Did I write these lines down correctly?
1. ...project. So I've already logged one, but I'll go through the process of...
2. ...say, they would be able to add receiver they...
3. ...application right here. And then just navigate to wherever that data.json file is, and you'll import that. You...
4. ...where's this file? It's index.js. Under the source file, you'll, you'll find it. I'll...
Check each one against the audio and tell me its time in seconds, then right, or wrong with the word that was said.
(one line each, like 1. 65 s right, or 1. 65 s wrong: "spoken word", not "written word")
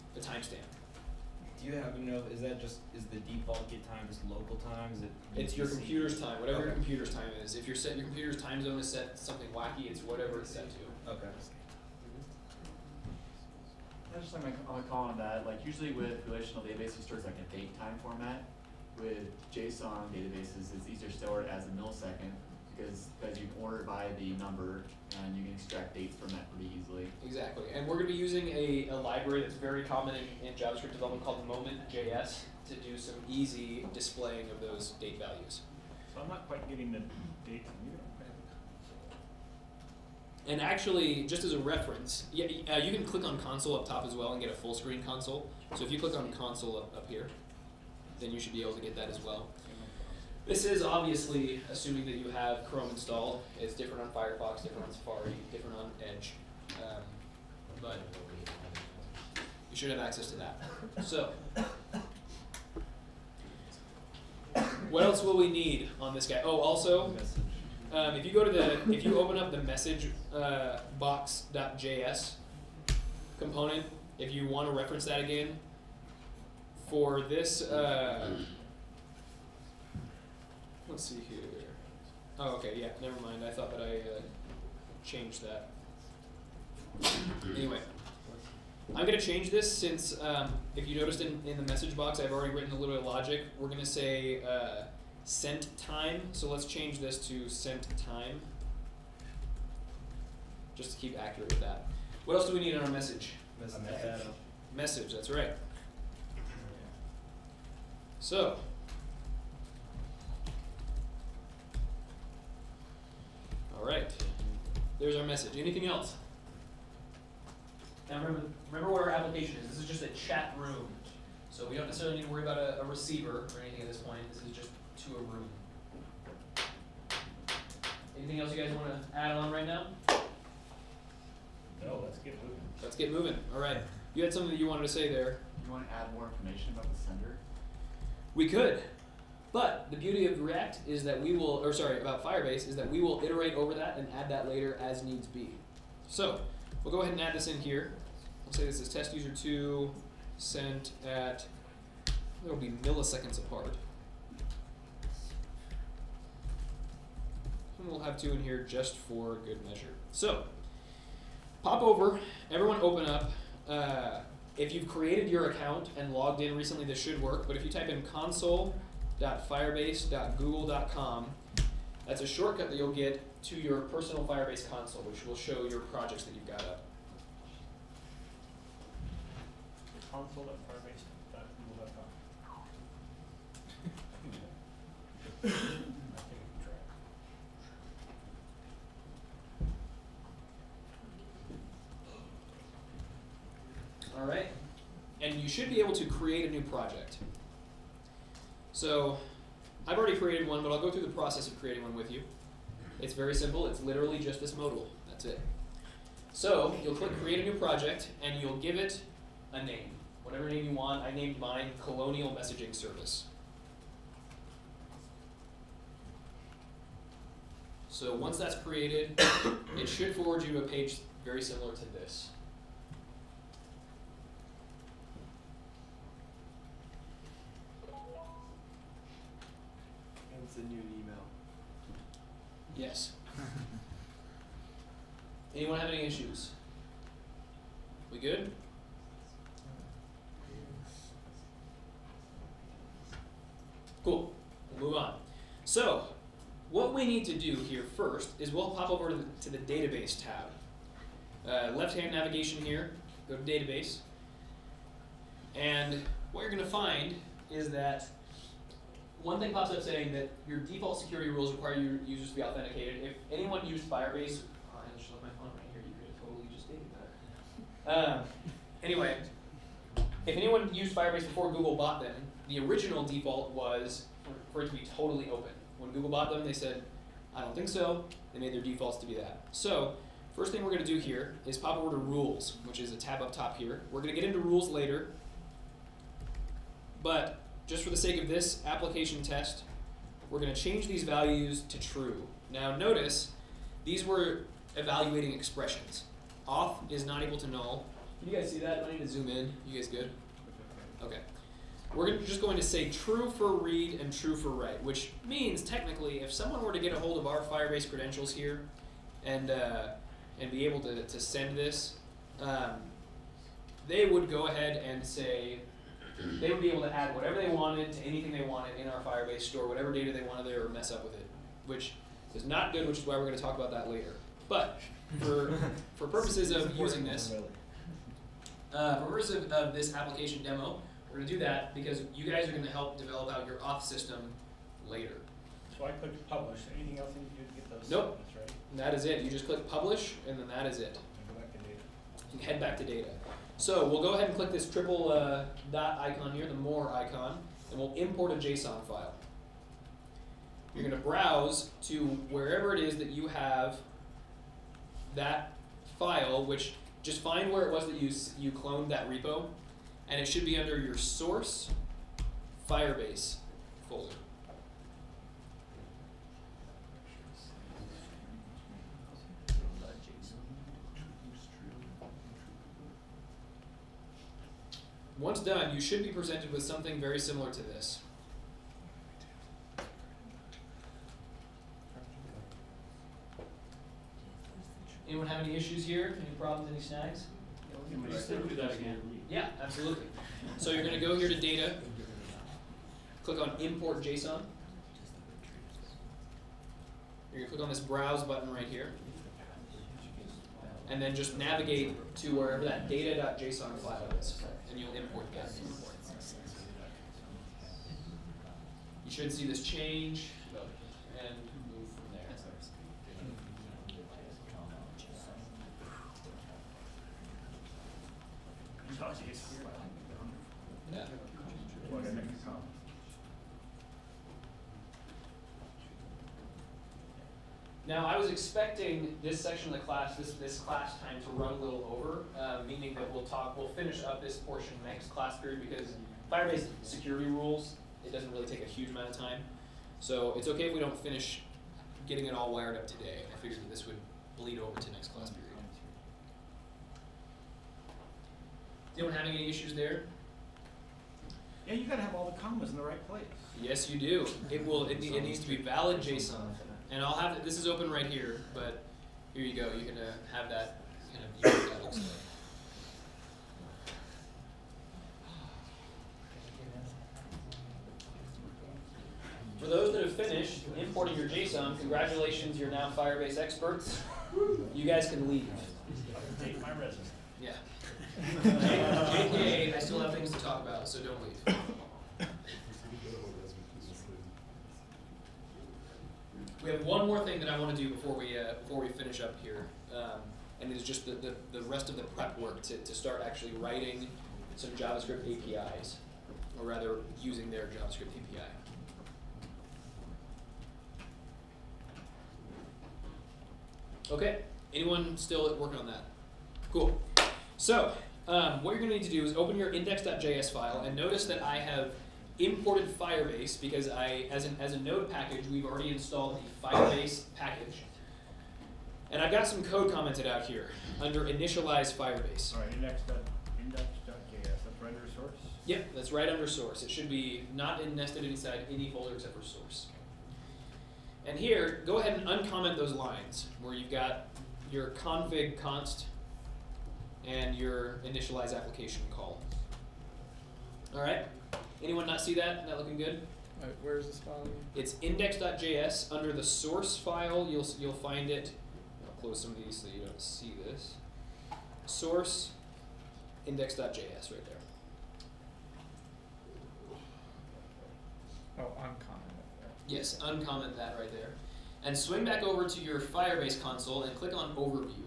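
1. 196 s wrong: "created", not "logged"
2. 315 s wrong: "whatever", not "receiver"
3. 398 s wrong: "button", not "application"
4. 543 s right.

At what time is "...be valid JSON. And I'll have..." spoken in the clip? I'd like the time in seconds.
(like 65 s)
455 s.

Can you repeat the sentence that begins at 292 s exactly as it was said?
Now notice these were evaluating expressions.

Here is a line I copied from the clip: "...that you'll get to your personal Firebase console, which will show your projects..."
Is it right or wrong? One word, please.
right.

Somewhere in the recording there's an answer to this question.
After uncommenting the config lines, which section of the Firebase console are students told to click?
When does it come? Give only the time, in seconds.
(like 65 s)
564 s.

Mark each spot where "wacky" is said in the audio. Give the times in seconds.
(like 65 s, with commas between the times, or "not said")
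9 s.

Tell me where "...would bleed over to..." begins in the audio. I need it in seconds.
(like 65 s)
443 s.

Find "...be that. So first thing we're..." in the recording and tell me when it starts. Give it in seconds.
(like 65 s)
279 s.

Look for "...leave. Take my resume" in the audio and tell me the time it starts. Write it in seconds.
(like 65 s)
475 s.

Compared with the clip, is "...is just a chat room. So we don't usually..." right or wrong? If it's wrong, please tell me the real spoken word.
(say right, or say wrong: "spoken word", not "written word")
wrong: "necessarily", not "usually".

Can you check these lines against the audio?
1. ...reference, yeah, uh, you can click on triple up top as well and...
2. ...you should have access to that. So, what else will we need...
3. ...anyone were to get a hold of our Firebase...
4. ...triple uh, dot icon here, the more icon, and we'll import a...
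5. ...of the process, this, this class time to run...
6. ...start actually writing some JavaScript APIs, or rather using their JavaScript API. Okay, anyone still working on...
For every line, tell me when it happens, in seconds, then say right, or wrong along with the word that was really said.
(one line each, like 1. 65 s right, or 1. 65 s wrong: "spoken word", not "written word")
1. 41 s wrong: "console", not "triple"
2. 59 s right
3. 306 s wrong: "someone", not "anyone"
4. 344 s right
5. 429 s wrong: "class", not "process"
6. 492 s right.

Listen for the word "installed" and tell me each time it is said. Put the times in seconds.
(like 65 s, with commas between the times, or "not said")
52 s, 515 s.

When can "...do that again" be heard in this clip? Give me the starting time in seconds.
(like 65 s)
388 s.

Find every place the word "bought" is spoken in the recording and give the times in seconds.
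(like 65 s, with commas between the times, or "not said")
271 s, 276 s.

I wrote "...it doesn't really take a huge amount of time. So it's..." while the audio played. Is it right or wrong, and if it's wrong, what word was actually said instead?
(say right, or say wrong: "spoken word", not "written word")
right.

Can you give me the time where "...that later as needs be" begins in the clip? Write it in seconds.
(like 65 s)
144 s.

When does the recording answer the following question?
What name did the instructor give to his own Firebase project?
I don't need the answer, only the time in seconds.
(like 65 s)
211 s.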